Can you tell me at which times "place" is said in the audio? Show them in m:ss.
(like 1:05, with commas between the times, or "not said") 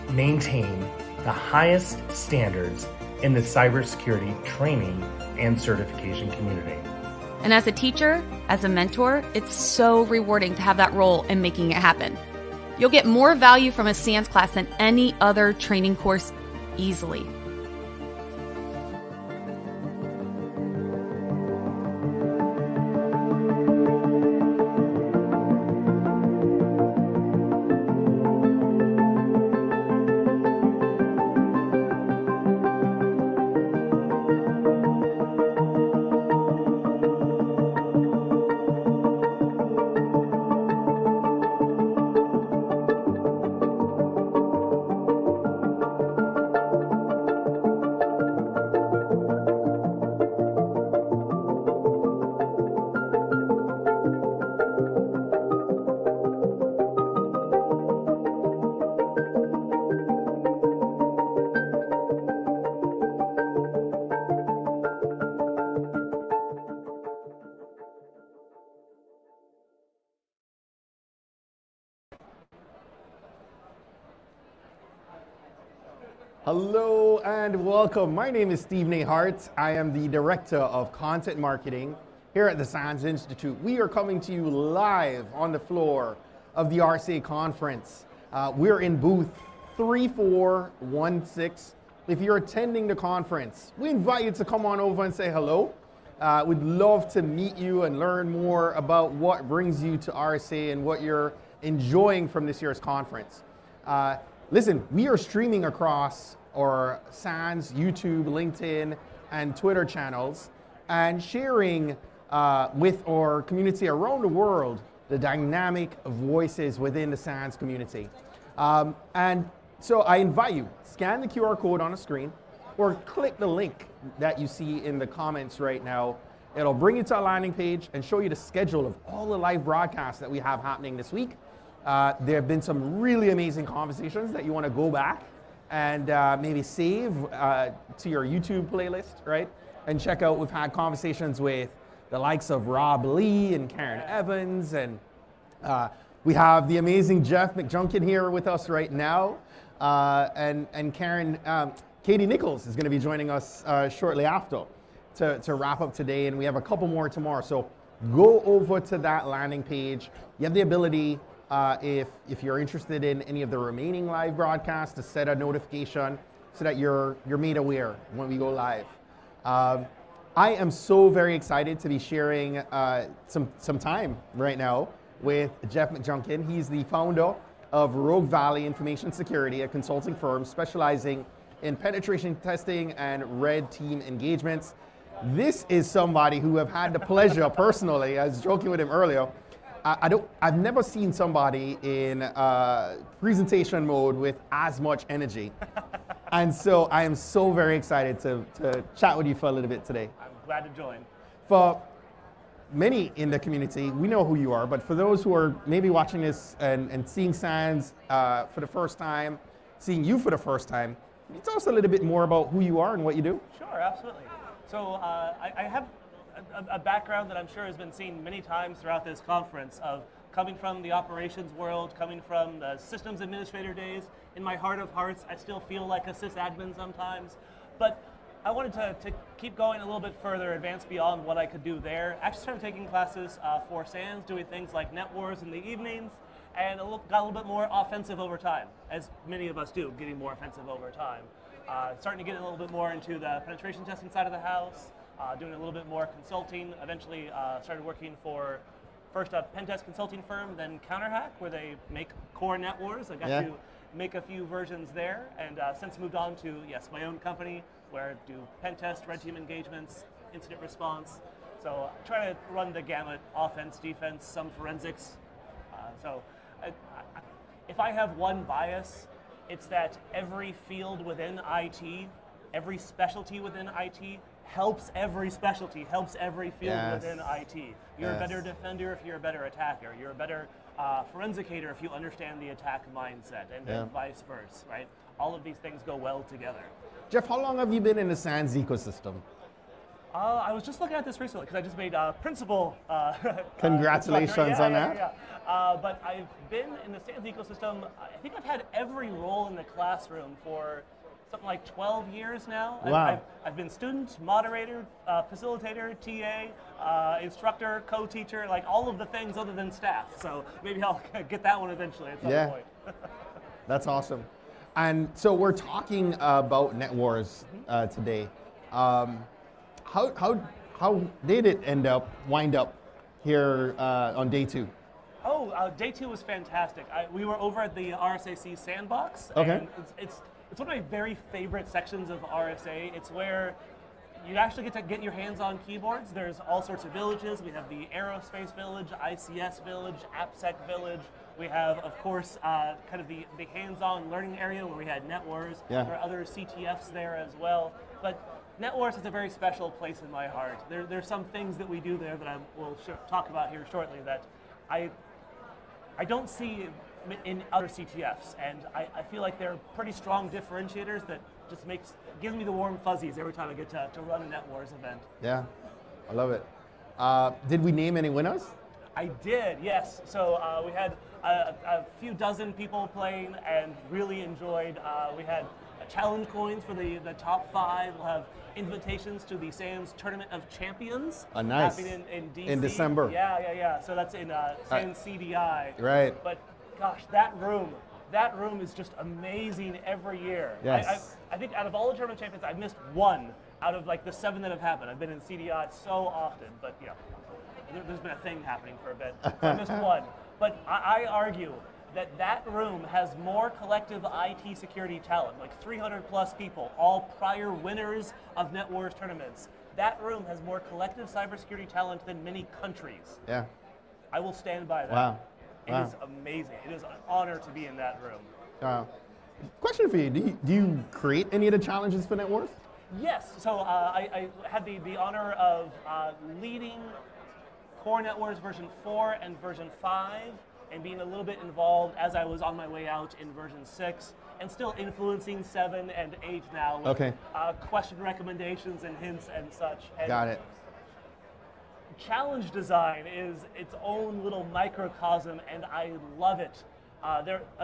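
5:49.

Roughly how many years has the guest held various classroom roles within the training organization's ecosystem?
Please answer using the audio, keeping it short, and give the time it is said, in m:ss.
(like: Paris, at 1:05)
12, at 5:01.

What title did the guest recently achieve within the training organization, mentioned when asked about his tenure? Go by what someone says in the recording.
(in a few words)
Principal.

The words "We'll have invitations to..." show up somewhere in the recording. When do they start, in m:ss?
6:17.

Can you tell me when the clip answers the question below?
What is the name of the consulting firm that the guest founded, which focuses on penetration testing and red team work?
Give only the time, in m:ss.
2:57.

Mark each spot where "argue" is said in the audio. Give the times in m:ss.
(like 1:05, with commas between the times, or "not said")
6:41.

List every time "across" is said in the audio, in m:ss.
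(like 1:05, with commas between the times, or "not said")
1:45.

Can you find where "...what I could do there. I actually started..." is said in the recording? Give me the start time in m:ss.
3:51.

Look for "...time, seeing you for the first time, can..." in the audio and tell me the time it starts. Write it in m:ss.
3:28.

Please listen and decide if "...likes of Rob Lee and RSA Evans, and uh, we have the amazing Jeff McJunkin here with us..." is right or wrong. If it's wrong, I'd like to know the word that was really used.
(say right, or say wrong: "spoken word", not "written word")
wrong: "Karen", not "RSA".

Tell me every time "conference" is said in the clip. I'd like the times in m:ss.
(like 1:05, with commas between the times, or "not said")
1:27, 1:32, 1:42, 3:39.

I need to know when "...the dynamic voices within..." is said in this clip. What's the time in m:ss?
1:55.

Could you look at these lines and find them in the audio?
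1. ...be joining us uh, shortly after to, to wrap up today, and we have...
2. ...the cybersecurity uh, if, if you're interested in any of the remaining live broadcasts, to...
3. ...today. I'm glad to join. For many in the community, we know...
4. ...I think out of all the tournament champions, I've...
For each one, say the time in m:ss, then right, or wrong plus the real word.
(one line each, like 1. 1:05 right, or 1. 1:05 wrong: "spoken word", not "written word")
1. 2:32 right
2. 2:40 wrong: "ability", not "cybersecurity"
3. 3:19 right
4. 6:31 right.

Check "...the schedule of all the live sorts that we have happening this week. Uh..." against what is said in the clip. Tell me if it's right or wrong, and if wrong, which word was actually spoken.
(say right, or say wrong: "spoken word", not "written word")
wrong: "broadcasts", not "sorts".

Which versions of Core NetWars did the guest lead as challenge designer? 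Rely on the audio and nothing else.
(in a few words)
Versions 4 and 5.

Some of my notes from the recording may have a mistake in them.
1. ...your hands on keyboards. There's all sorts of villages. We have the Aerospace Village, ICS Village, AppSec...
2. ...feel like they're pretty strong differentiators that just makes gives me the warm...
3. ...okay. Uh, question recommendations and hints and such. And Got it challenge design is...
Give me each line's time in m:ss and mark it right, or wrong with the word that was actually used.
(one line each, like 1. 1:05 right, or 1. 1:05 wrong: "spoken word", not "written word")
1. 5:35 right
2. 5:59 right
3. 7:16 right.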